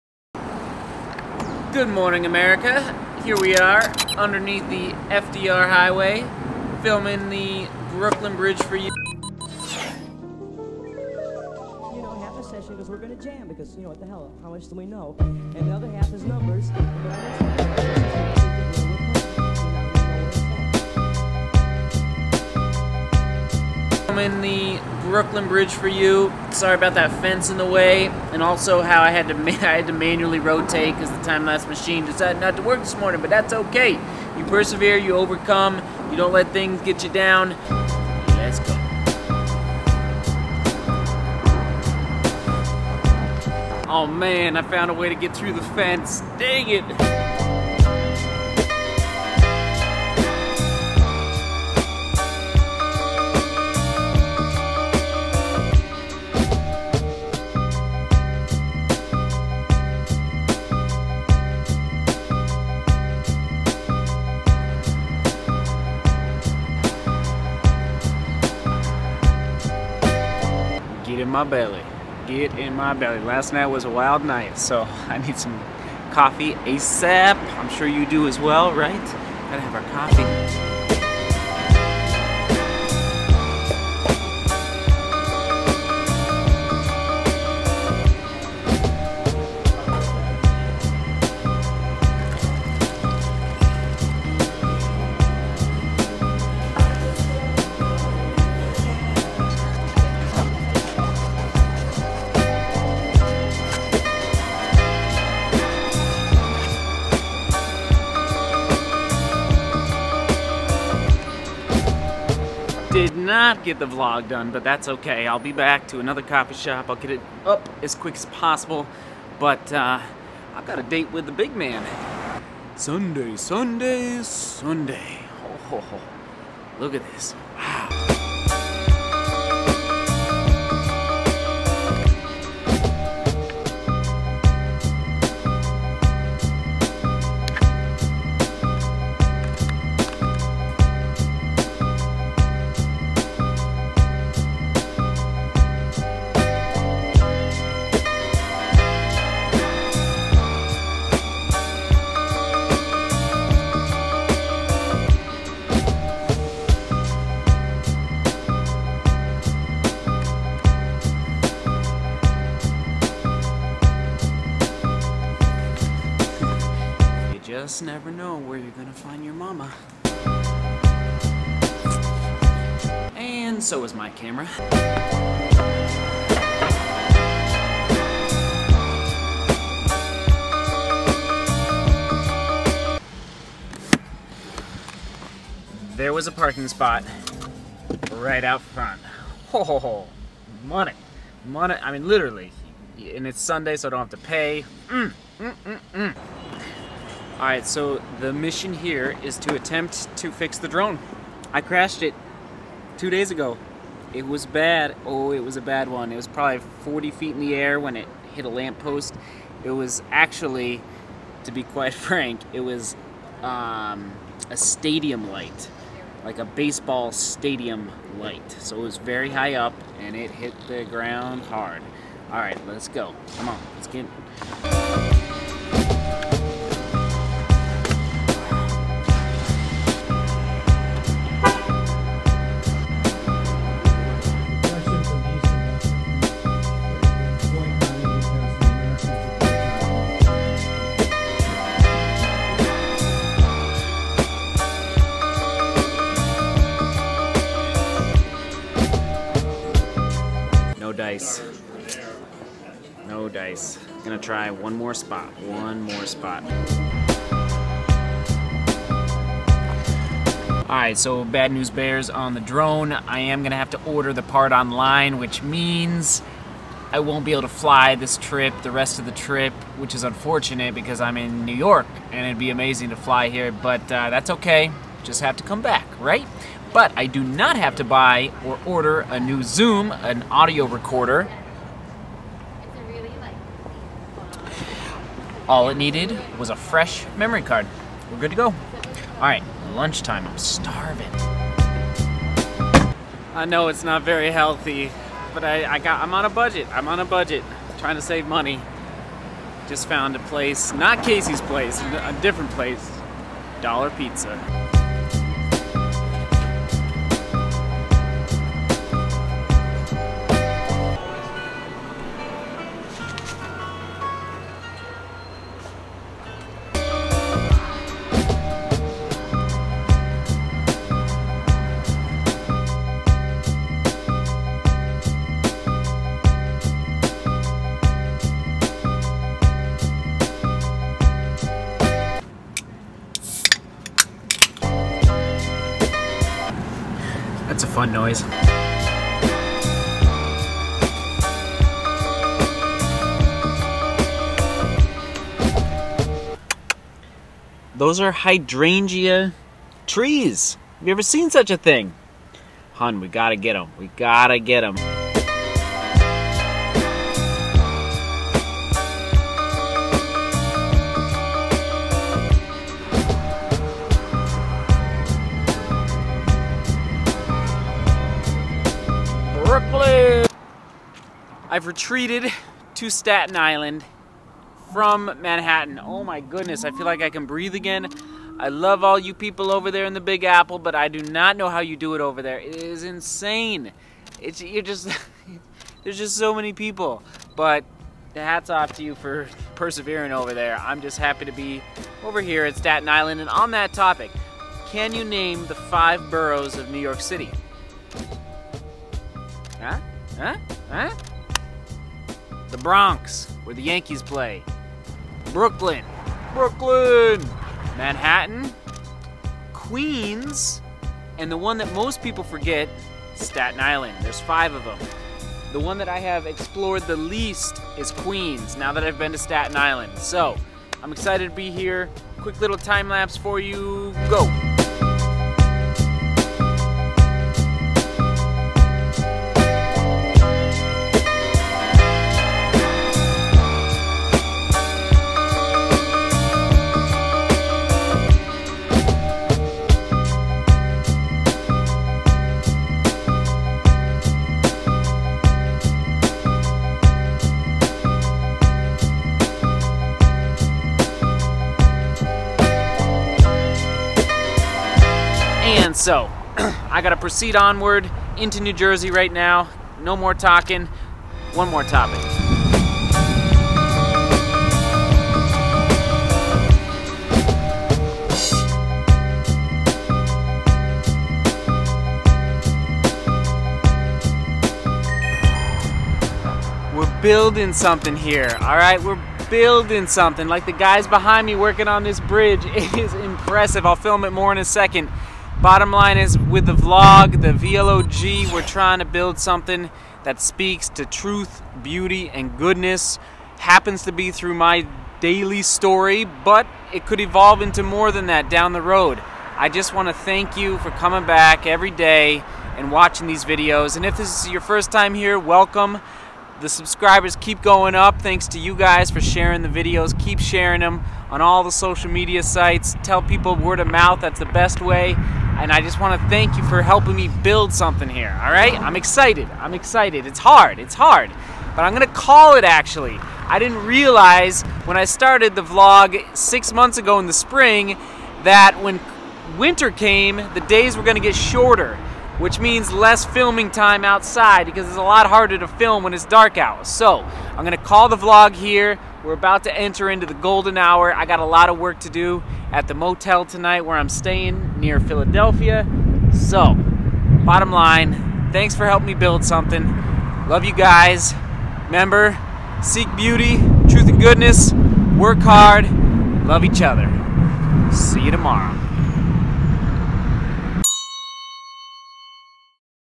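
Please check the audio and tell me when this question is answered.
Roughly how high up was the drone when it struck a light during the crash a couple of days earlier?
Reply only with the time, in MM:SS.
03:26.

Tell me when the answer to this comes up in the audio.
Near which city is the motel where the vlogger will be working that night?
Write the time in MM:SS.
09:04.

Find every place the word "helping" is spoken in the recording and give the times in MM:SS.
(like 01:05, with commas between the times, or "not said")
08:36, 09:08.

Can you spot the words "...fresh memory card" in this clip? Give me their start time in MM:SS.
04:46.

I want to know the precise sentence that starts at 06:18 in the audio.
I love all you people over there in the Big Apple, but I do not know how you do it over there.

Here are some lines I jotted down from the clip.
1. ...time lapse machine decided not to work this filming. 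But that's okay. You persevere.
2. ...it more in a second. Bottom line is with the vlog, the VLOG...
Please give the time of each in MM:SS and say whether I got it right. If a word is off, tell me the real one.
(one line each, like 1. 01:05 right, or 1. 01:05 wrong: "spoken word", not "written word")
1. 00:31 wrong: "morning", not "filming"
2. 08:04 right.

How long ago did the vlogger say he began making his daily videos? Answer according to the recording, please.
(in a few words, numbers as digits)
6 months.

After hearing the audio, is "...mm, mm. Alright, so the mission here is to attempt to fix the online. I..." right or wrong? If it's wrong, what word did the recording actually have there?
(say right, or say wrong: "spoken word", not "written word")
wrong: "drone", not "online".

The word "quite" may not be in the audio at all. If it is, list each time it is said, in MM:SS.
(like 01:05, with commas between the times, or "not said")
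03:31.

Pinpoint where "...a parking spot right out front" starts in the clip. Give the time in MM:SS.
03:06.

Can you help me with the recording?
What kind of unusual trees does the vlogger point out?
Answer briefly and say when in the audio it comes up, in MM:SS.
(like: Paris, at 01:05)
Hydrangea trees, at 05:48.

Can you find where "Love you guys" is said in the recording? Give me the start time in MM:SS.
09:10.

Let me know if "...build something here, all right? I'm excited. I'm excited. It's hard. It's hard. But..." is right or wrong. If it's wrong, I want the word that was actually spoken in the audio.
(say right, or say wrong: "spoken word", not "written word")
right.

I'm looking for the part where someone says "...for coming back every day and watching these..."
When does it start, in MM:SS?
08:20.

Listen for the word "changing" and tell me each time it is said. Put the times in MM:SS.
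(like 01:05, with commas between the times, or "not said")
not said.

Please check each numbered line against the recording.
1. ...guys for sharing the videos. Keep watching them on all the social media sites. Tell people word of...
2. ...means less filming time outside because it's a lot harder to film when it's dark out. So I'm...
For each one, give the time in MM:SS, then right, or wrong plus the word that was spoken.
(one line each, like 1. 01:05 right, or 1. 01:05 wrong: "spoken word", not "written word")
1. 08:28 wrong: "sharing", not "watching"
2. 08:52 right.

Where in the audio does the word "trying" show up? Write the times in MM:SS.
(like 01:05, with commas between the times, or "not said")
04:57, 08:08.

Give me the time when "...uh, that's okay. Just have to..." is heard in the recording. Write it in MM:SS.
04:33.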